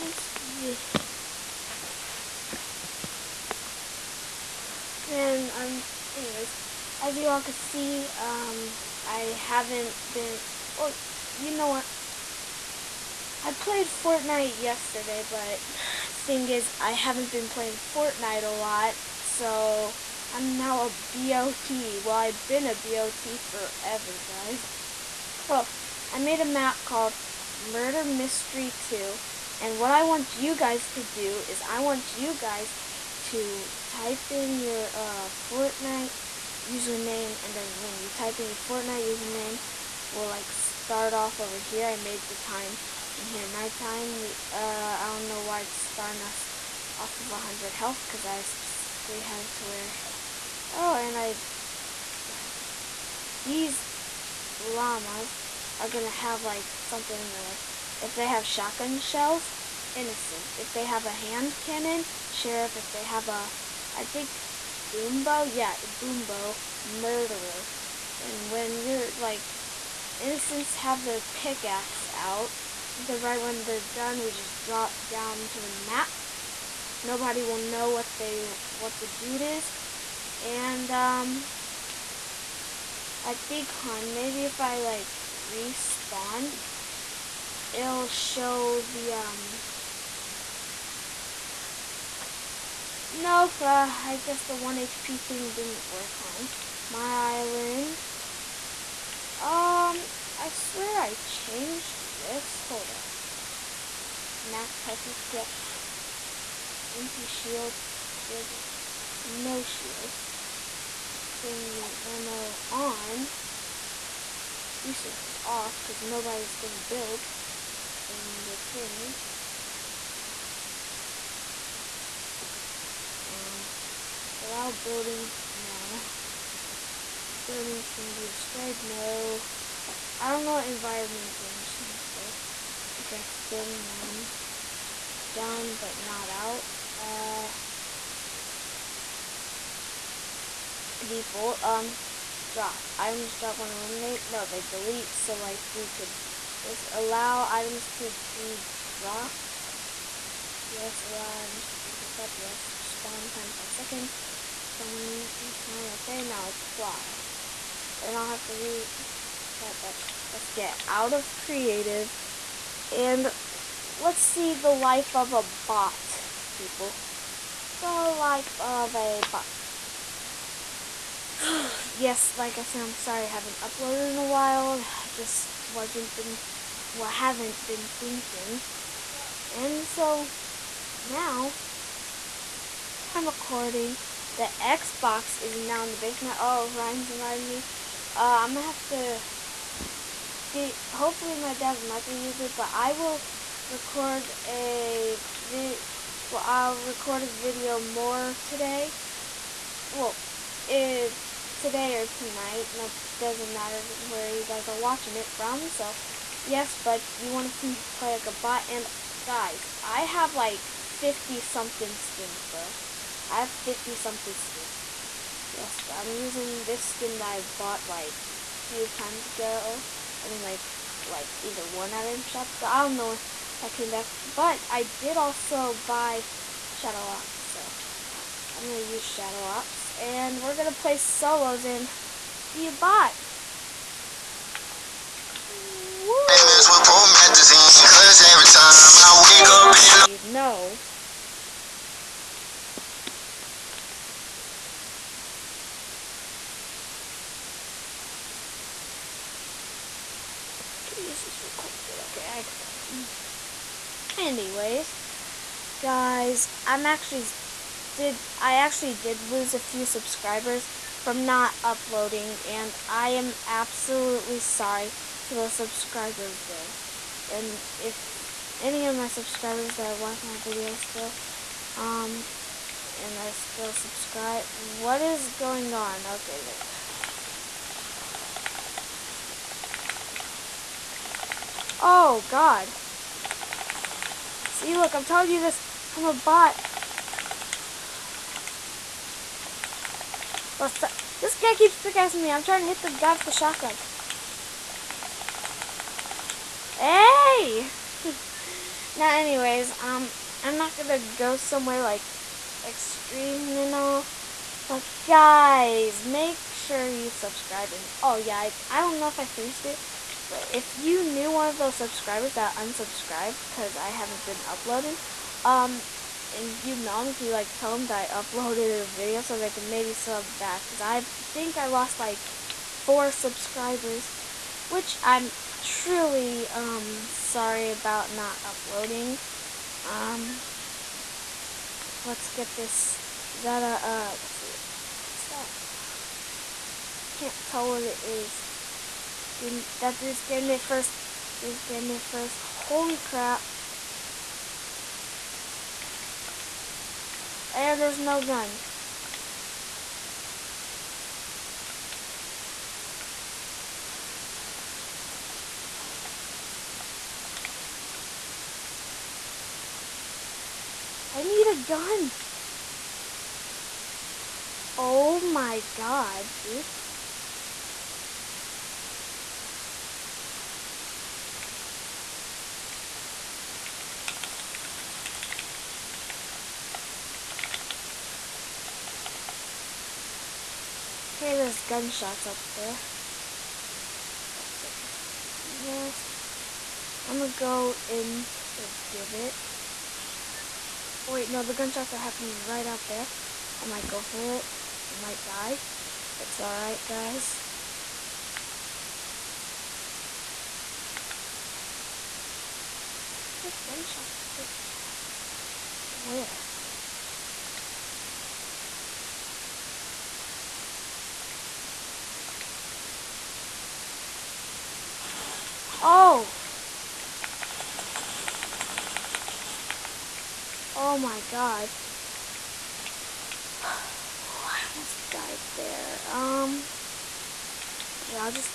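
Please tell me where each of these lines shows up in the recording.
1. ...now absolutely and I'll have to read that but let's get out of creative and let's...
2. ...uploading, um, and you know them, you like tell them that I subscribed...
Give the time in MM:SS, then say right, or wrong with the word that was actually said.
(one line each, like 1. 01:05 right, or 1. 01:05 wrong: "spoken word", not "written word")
1. 02:36 wrong: "apply", not "absolutely"
2. 05:14 wrong: "uploaded", not "subscribed".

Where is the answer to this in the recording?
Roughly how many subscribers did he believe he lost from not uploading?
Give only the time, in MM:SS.
05:22.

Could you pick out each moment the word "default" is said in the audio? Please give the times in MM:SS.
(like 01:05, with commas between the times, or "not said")
02:21.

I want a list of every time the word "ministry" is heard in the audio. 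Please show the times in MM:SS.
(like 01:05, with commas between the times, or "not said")
not said.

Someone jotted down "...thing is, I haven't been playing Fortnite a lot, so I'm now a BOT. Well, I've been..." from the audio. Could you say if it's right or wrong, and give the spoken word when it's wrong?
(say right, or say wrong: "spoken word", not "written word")
right.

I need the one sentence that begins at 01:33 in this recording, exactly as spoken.
Nope, uh, I guess the 1 HP thing didn't work on my island.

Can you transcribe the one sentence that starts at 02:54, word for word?
I just wasn't been, well, haven't been thinking.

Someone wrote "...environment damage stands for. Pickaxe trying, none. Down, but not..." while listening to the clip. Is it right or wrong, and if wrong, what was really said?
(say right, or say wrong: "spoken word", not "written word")
wrong: "building", not "trying".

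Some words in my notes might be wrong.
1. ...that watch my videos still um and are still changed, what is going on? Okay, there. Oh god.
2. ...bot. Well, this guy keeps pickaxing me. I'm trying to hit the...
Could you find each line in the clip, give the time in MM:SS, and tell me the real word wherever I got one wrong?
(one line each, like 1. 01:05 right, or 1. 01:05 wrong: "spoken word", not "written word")
1. 04:29 wrong: "subscribed", not "changed"
2. 04:46 right.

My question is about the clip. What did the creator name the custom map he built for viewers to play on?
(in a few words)
Murder Mystery 2.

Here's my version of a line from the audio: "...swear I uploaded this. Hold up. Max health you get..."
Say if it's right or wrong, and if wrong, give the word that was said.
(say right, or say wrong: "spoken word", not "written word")
wrong: "changed", not "uploaded".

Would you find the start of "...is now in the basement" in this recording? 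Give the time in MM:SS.
03:05.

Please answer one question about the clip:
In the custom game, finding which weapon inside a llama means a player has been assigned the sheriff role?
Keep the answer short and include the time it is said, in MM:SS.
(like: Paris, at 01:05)
Hand cannon, at 01:01.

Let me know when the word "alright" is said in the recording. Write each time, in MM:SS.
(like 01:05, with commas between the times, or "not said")
06:36.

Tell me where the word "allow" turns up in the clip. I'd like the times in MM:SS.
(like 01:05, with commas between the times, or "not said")
02:04, 02:26, 02:31.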